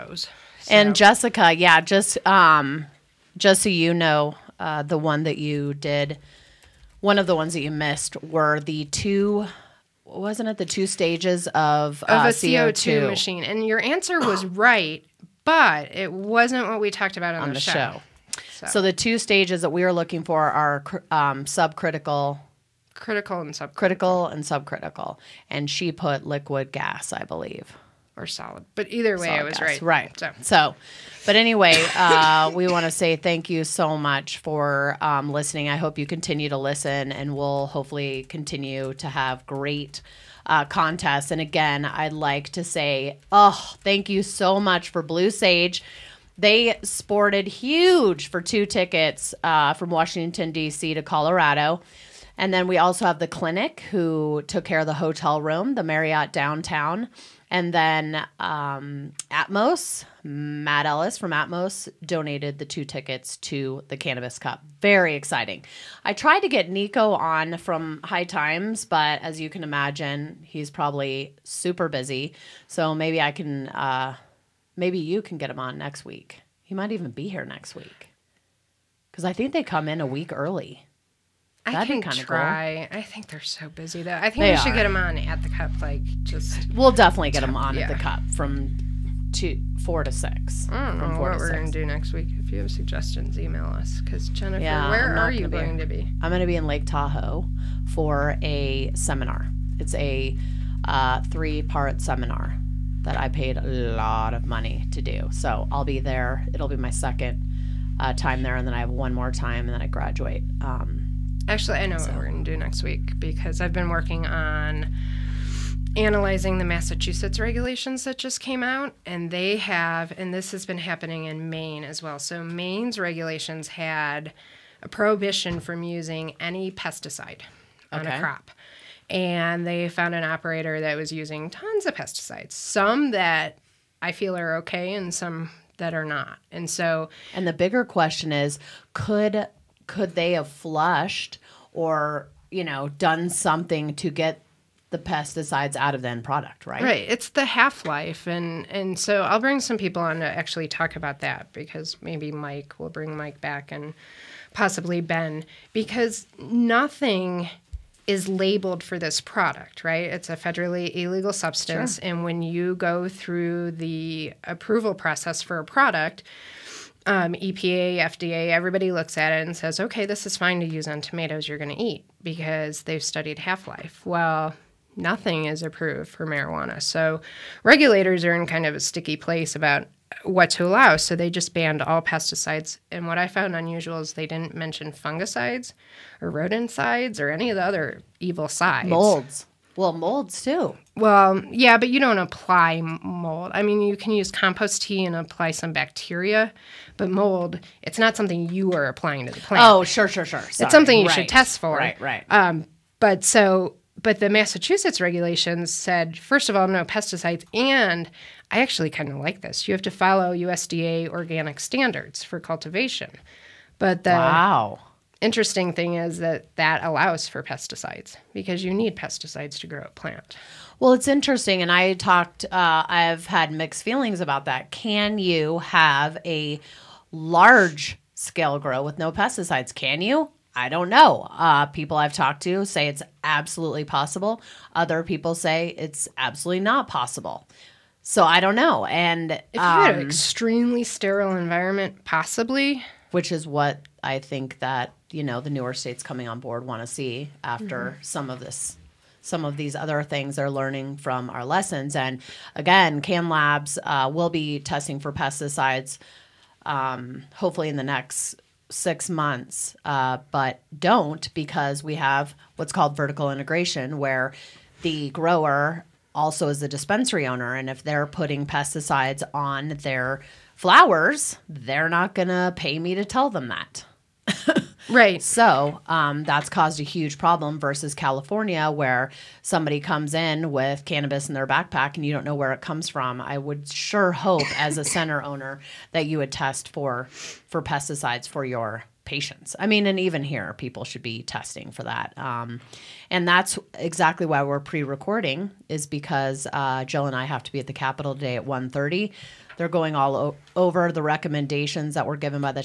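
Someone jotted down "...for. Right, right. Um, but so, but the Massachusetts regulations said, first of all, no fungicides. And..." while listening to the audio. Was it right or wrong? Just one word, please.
wrong.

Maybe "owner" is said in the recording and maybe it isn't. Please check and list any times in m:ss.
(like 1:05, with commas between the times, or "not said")
4:27, 4:45.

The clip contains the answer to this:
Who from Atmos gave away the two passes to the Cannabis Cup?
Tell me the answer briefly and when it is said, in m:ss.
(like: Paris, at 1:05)
Matt Ellis, at 1:00.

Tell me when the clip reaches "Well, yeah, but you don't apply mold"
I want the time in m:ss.
3:10.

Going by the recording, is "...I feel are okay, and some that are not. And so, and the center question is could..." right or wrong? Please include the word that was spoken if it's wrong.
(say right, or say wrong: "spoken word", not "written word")
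wrong: "bigger", not "center".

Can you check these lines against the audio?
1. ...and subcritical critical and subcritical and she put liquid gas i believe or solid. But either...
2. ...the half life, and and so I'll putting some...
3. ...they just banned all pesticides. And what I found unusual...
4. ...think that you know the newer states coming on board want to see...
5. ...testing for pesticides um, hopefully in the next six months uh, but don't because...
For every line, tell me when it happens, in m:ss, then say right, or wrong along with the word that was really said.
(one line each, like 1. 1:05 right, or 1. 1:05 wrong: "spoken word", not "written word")
1. 0:23 right
2. 2:27 wrong: "bring", not "putting"
3. 3:01 right
4. 4:04 right
5. 4:14 right.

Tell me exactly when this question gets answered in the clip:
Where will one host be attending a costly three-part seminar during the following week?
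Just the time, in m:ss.
1:36.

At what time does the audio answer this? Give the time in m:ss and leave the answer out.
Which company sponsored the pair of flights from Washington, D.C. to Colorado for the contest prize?
0:45.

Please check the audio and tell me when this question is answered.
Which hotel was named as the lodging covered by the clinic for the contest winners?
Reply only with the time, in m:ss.
0:55.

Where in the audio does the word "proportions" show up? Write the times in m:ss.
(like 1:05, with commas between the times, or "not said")
not said.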